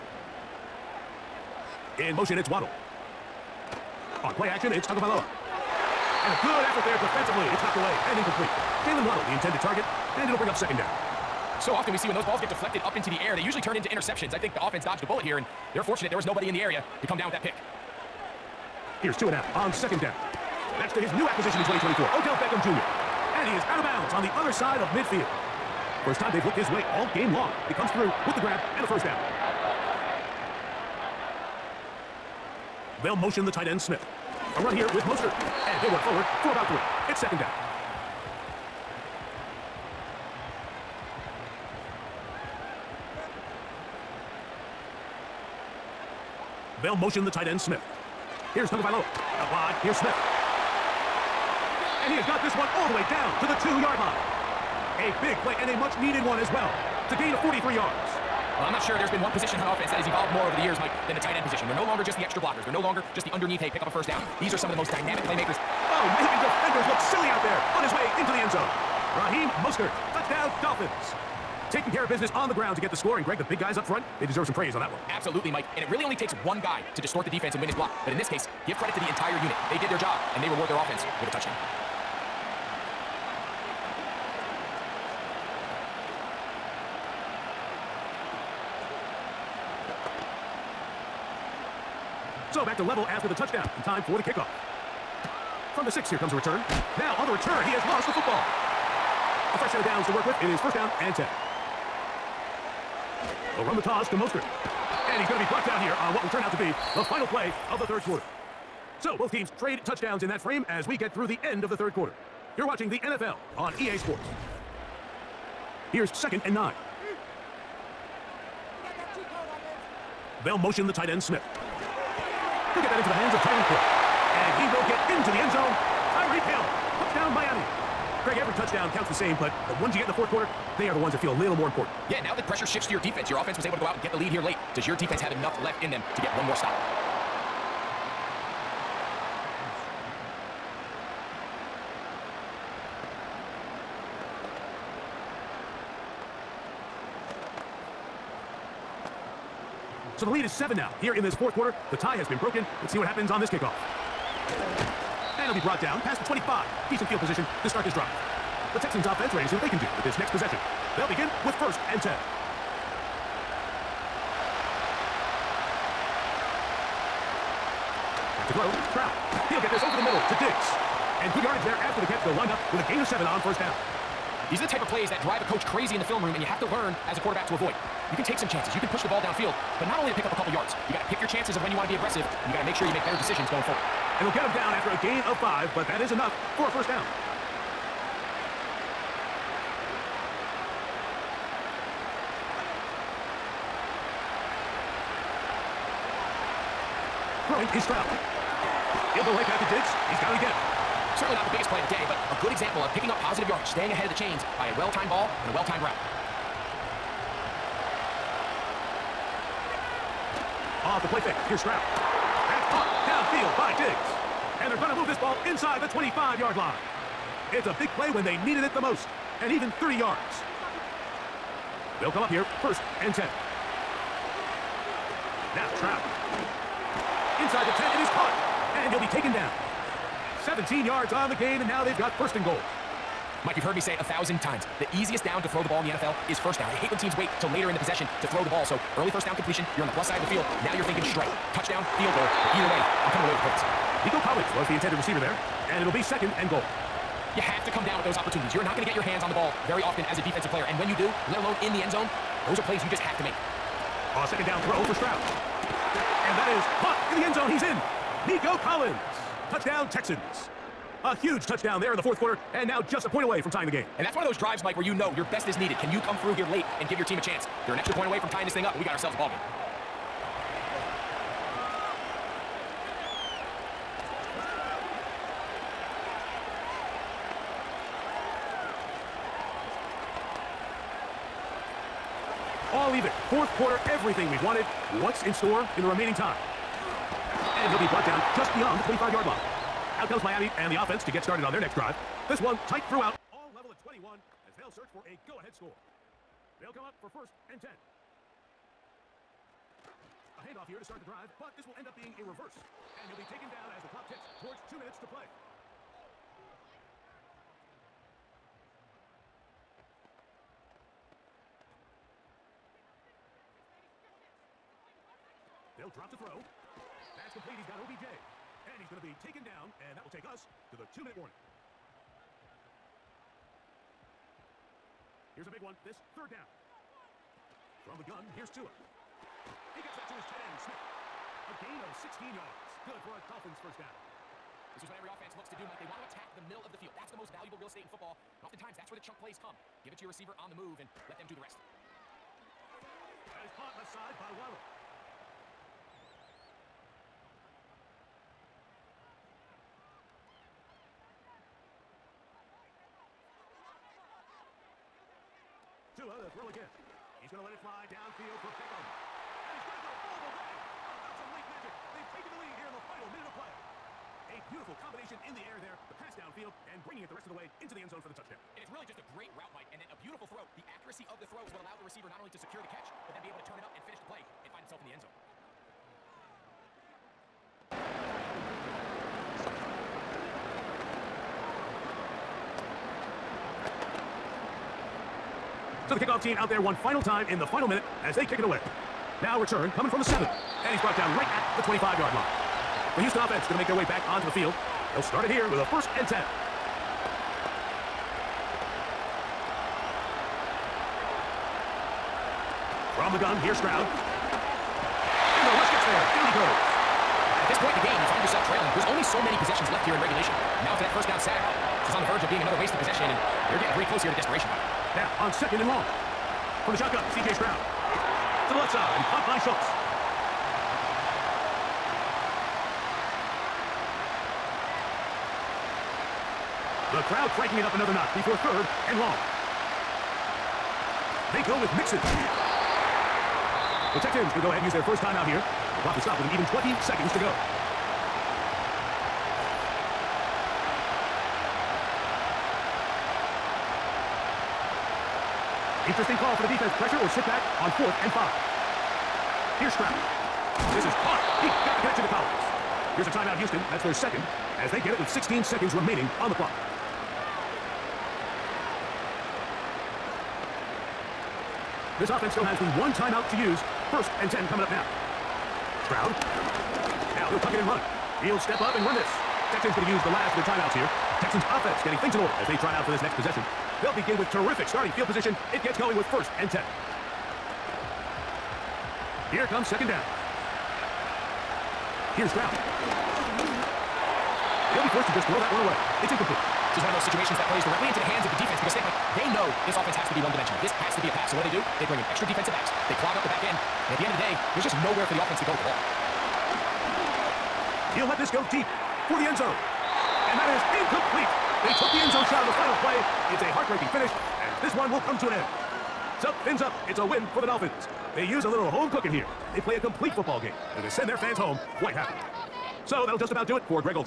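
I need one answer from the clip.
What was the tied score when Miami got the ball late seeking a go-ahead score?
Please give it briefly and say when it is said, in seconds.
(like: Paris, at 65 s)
21, at 293 s.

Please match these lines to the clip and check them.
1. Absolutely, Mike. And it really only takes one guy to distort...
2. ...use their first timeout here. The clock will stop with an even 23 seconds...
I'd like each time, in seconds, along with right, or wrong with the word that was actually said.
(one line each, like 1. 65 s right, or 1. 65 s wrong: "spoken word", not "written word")
1. 75 s right
2. 434 s wrong: "20", not "23".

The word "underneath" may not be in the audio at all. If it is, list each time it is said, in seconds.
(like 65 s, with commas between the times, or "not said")
63 s.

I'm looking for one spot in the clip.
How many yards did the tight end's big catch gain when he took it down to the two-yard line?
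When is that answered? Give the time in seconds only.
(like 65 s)
57 s.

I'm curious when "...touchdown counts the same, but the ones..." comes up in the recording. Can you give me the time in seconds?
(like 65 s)
128 s.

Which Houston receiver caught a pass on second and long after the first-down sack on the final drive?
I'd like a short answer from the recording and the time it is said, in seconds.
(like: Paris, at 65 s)
Schultz, at 419 s.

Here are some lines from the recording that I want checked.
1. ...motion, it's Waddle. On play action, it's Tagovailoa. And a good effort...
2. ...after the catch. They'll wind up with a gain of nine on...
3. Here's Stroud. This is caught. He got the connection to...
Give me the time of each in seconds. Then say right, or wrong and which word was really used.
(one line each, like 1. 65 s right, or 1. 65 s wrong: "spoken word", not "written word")
1. 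2 s right
2. 171 s wrong: "seven", not "nine"
3. 449 s right.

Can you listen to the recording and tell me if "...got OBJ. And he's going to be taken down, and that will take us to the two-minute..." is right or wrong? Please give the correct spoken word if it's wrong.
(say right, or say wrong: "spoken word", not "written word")
right.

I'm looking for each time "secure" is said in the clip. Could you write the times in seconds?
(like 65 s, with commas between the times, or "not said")
372 s.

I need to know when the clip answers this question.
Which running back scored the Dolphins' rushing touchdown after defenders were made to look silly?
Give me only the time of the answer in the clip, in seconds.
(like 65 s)
69 s.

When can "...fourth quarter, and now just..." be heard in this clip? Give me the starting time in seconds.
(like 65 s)
261 s.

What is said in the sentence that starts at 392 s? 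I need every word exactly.
The Houston offense going to make their way back onto the field.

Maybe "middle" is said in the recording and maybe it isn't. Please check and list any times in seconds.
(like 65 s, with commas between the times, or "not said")
170 s, 336 s.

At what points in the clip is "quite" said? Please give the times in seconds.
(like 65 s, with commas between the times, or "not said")
511 s.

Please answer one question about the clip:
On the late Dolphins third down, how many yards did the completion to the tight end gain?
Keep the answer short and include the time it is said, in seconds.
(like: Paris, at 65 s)
16, at 332 s.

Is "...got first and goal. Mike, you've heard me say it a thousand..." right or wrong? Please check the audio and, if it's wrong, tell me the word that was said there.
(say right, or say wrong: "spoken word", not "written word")
right.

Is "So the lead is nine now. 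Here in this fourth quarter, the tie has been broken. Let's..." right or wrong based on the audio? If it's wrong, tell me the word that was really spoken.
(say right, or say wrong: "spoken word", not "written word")
wrong: "seven", not "nine".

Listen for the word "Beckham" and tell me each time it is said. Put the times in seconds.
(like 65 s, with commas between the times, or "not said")
22 s, 358 s.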